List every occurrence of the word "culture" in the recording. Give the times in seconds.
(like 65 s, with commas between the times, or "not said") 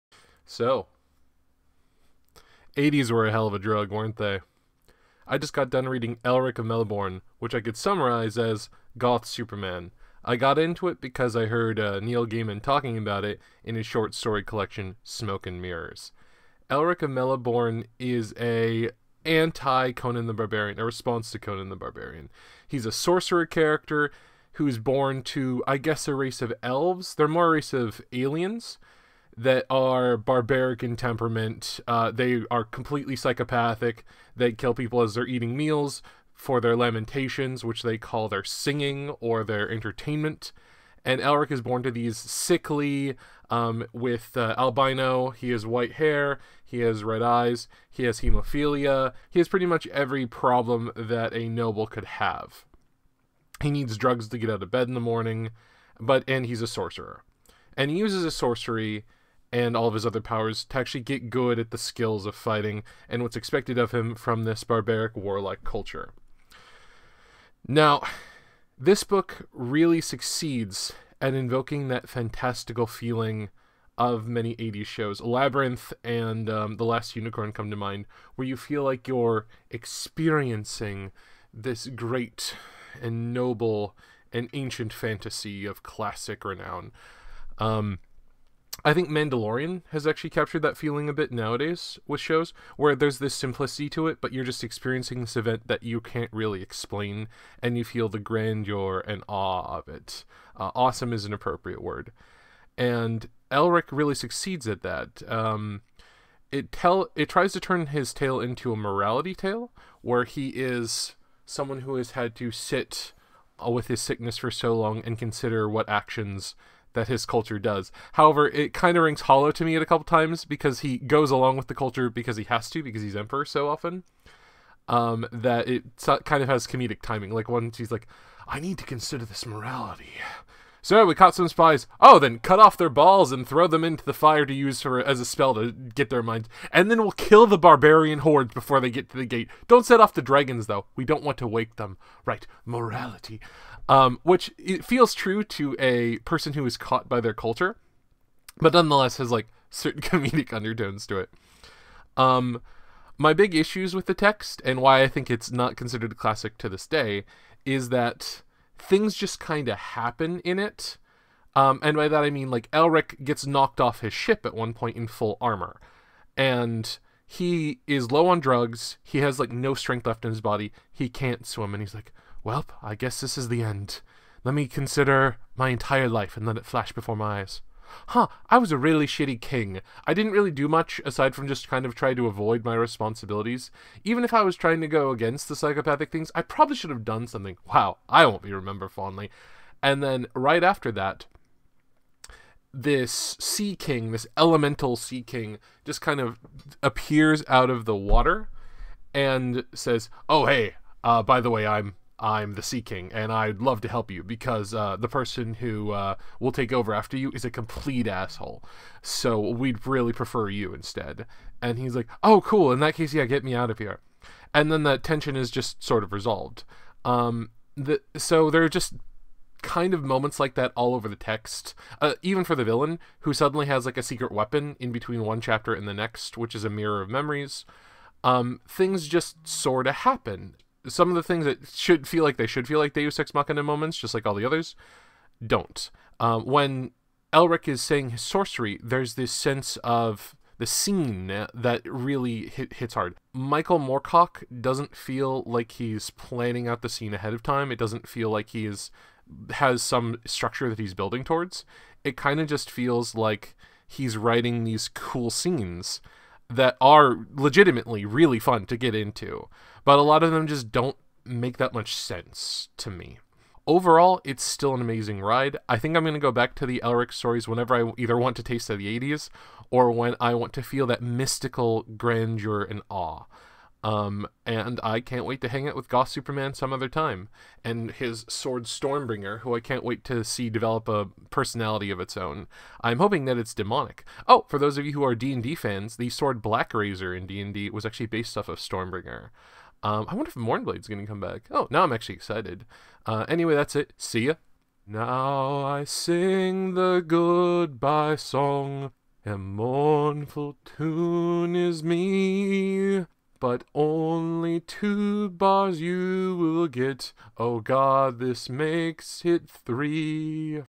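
65 s, 117 s, 121 s, 147 s.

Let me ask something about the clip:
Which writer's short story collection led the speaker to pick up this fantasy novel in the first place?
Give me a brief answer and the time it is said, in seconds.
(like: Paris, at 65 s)
Neil Gaiman, at 12 s.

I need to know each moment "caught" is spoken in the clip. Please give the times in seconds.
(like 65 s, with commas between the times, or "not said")
131 s, 146 s.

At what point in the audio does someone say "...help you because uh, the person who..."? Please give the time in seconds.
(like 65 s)
203 s.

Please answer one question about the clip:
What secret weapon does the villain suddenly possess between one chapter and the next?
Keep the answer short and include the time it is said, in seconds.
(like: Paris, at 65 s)
A mirror of memories, at 226 s.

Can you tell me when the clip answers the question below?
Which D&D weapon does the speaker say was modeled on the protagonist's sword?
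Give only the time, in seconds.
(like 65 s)
286 s.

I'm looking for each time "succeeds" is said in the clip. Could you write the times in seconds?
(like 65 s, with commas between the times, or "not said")
70 s, 104 s.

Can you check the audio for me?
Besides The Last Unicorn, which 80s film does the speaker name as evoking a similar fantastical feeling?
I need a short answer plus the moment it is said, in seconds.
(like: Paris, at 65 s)
Labyrinth, at 75 s.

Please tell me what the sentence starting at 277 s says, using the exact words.
And his sword Stormbringer, who I can't wait to see develop a personality of its own.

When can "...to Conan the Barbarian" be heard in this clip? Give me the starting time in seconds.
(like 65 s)
21 s.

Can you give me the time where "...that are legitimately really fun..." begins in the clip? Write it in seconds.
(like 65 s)
256 s.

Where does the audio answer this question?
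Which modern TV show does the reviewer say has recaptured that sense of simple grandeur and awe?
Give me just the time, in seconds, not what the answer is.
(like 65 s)
89 s.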